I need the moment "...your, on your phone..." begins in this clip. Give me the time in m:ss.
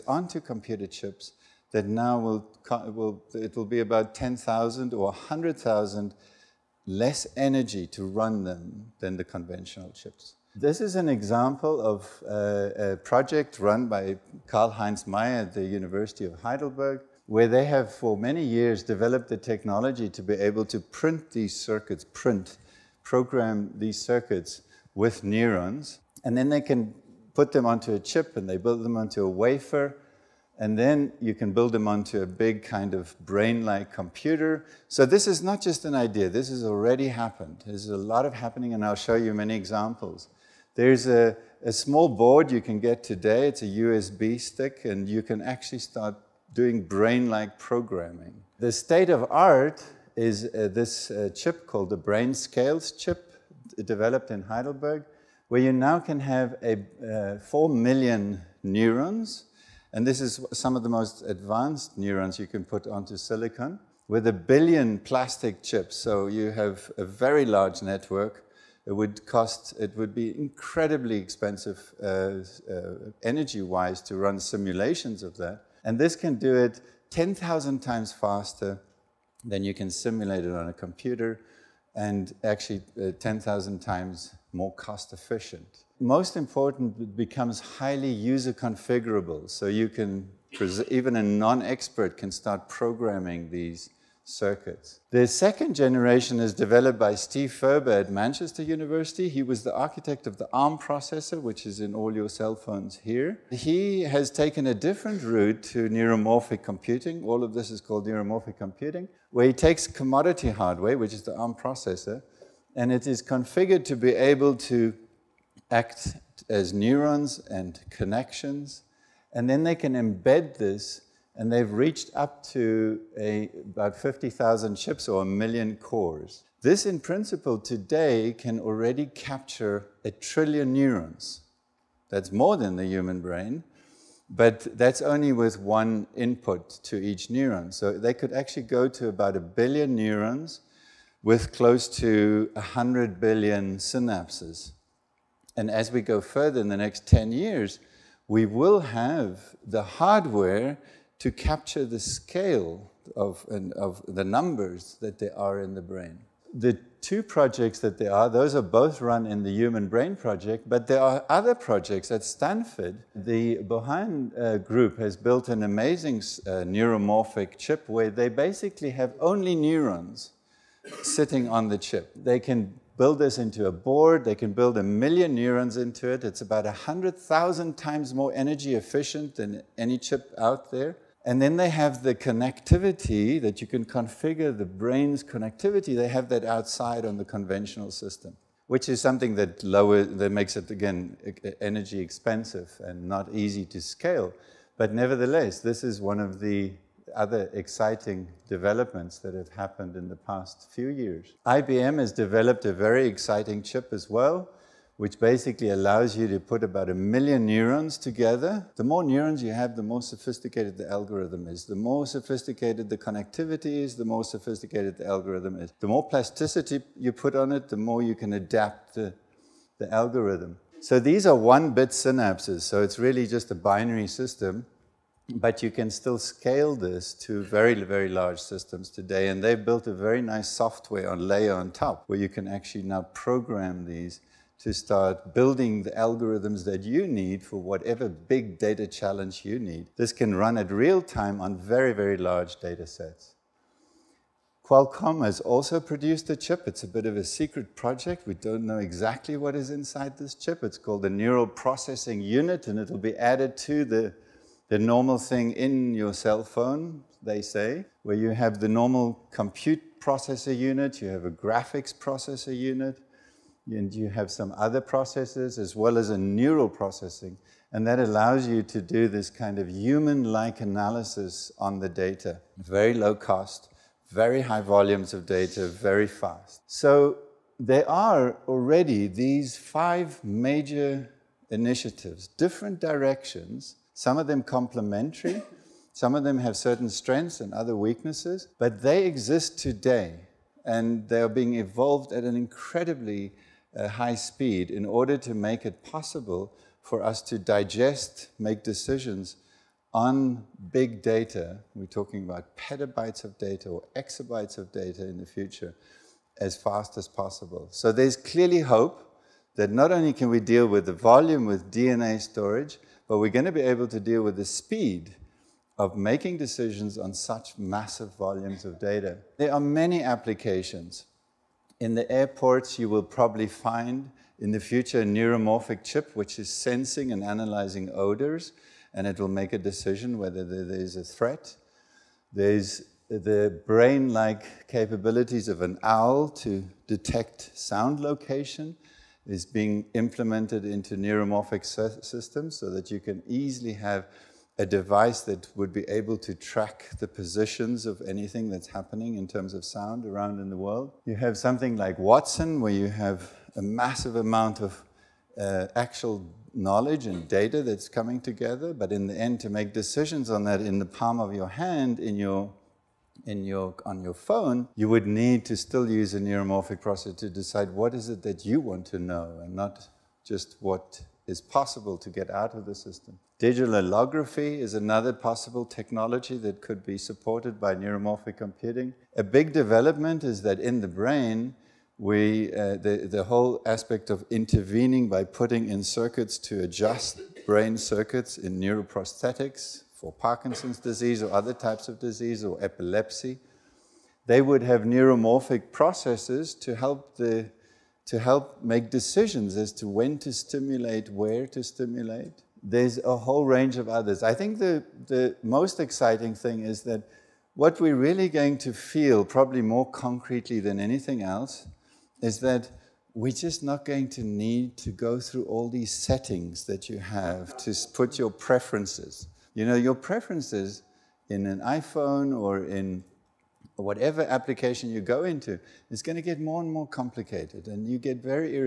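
6:03.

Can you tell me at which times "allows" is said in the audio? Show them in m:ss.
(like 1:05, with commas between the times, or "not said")
3:25, 4:27.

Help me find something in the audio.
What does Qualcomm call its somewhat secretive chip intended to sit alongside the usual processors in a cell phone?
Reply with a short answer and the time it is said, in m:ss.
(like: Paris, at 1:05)
Neural Processing Unit, at 4:11.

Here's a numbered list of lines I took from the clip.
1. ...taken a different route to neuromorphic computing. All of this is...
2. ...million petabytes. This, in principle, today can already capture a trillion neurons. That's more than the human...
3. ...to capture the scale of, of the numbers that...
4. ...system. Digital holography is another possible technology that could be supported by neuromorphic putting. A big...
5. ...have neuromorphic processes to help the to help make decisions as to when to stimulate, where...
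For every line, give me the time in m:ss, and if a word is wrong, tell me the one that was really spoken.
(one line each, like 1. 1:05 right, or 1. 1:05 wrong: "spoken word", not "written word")
1. 1:44 right
2. 2:05 wrong: "cores", not "petabytes"
3. 2:31 right
4. 6:12 wrong: "computing", not "putting"
5. 6:34 right.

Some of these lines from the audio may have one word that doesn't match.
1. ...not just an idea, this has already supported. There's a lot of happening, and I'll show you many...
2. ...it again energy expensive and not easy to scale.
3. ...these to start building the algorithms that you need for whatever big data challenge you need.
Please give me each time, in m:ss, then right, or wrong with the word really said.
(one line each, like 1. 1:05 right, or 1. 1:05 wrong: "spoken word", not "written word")
1. 0:35 wrong: "happened", not "supported"
2. 3:10 right
3. 3:53 right.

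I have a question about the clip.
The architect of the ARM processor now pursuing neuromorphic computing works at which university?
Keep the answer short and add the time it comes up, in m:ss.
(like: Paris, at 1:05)
Manchester University, at 1:38.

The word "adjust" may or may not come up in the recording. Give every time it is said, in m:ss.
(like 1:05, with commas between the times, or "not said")
6:26.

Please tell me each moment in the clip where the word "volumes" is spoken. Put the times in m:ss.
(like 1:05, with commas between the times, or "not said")
4:34, 5:10, 5:18.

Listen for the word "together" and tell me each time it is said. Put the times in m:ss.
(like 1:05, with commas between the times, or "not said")
3:27, 5:58.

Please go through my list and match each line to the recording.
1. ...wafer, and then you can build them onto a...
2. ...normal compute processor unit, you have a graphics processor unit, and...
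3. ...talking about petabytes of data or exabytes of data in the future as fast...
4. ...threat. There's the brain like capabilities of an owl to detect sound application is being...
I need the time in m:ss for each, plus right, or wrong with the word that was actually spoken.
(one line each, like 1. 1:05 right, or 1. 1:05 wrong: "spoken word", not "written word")
1. 0:29 right
2. 4:18 right
3. 5:01 right
4. 5:31 wrong: "location", not "application".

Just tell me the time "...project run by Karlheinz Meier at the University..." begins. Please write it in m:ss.
0:12.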